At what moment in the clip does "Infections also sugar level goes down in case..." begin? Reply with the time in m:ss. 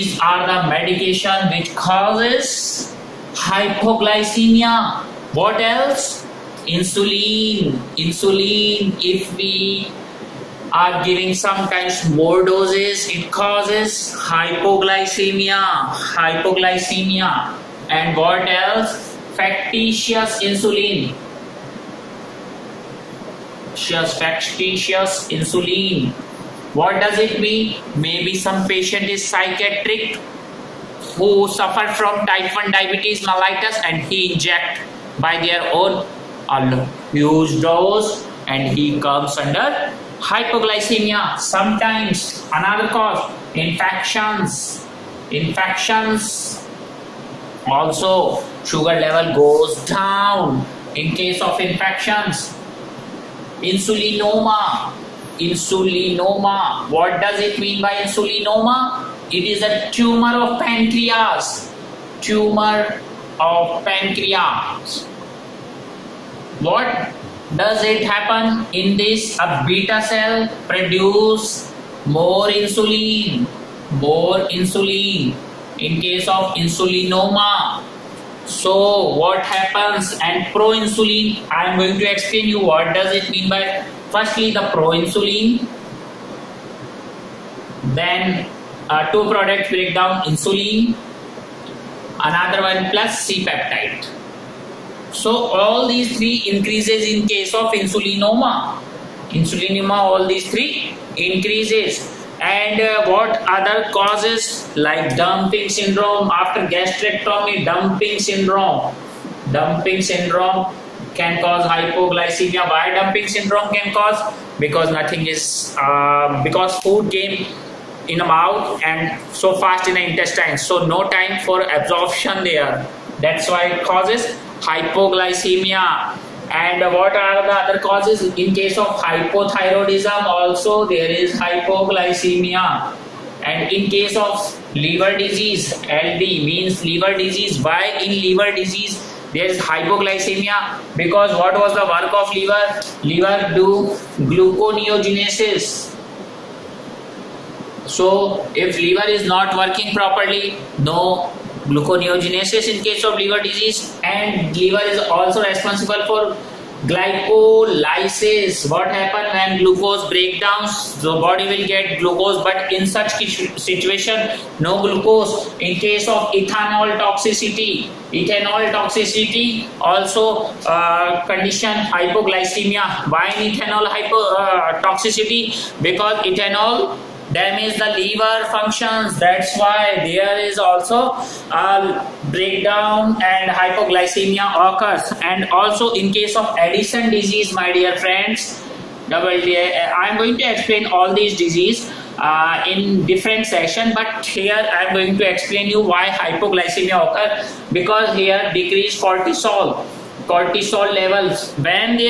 0:45.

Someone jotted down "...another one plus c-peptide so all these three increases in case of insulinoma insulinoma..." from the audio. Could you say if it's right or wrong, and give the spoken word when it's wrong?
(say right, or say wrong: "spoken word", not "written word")
right.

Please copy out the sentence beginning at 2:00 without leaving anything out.
So no time for absorption there.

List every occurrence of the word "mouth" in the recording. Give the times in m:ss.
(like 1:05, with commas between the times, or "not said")
1:58.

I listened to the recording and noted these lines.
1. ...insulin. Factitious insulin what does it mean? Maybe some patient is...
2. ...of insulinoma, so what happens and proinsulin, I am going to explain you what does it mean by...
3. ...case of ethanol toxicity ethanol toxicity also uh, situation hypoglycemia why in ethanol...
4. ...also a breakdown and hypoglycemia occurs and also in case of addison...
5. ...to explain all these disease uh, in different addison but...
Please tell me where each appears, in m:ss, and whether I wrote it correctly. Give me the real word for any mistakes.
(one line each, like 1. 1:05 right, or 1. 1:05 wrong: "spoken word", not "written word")
1. 0:20 right
2. 1:16 right
3. 2:45 wrong: "condition", not "situation"
4. 3:00 right
5. 3:10 wrong: "section", not "addison".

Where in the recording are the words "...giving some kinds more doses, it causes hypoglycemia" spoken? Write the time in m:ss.
0:11.